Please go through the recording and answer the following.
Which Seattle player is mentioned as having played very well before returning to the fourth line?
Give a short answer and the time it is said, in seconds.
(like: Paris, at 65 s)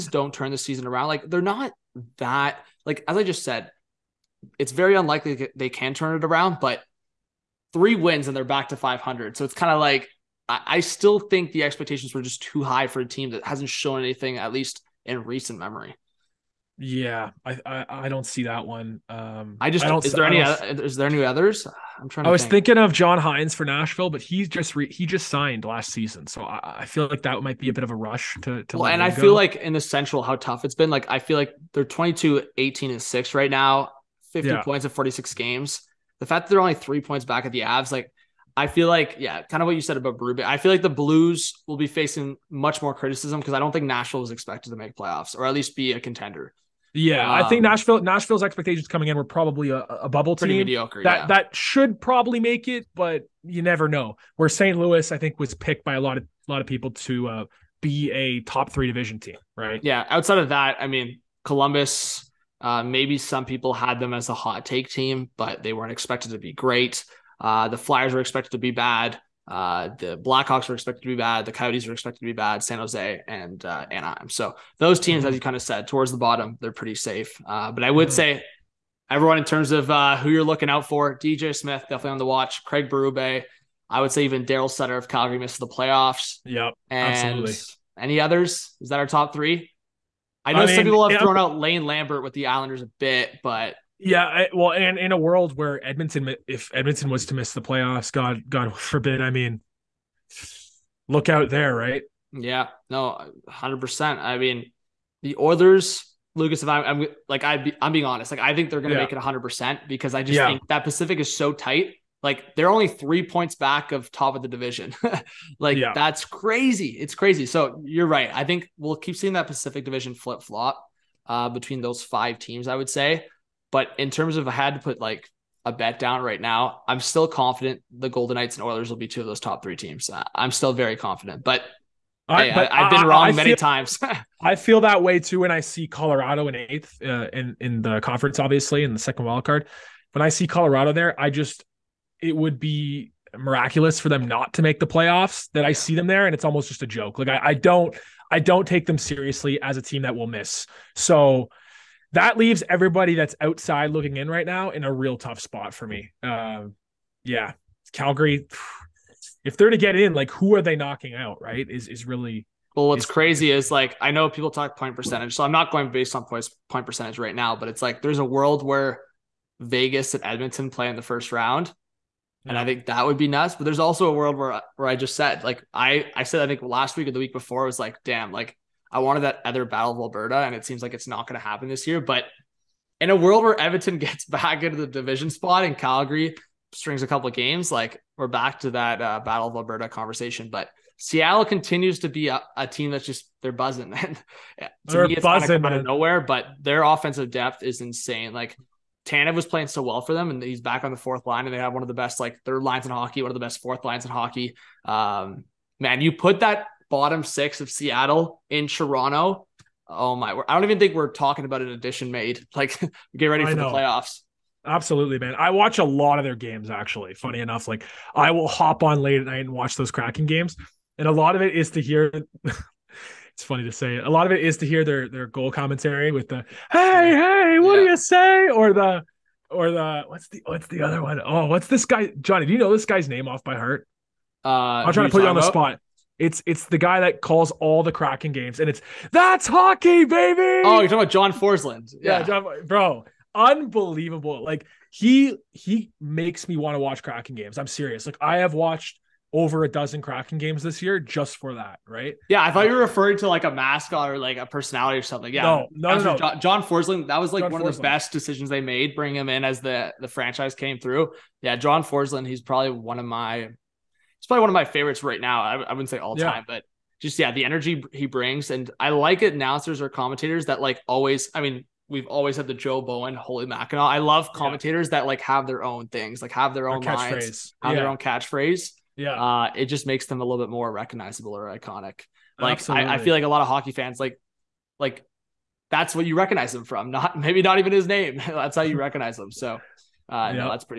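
Tanev, at 199 s.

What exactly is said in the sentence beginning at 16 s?
Yeah, I, I I, don't see that one.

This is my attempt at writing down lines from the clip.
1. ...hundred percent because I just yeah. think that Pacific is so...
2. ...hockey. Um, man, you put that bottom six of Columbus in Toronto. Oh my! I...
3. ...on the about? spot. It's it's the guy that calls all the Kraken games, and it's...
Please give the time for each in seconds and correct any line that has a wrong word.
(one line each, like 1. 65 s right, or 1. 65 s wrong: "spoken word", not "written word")
1. 109 s right
2. 204 s wrong: "Seattle", not "Columbus"
3. 235 s right.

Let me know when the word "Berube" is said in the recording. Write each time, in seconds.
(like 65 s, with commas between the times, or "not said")
40 s, 82 s.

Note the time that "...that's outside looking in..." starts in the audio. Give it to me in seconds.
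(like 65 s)
153 s.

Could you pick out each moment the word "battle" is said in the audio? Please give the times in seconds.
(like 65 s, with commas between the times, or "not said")
179 s, 189 s.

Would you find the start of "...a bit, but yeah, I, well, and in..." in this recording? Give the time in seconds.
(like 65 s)
92 s.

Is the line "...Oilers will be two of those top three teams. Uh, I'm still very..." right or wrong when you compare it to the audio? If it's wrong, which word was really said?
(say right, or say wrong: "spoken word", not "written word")
right.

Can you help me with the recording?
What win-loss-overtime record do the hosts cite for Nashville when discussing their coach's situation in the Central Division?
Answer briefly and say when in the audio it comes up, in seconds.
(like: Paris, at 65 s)
22-18-6, at 31 s.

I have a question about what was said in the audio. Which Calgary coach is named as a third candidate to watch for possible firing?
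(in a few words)
Daryl Sutter.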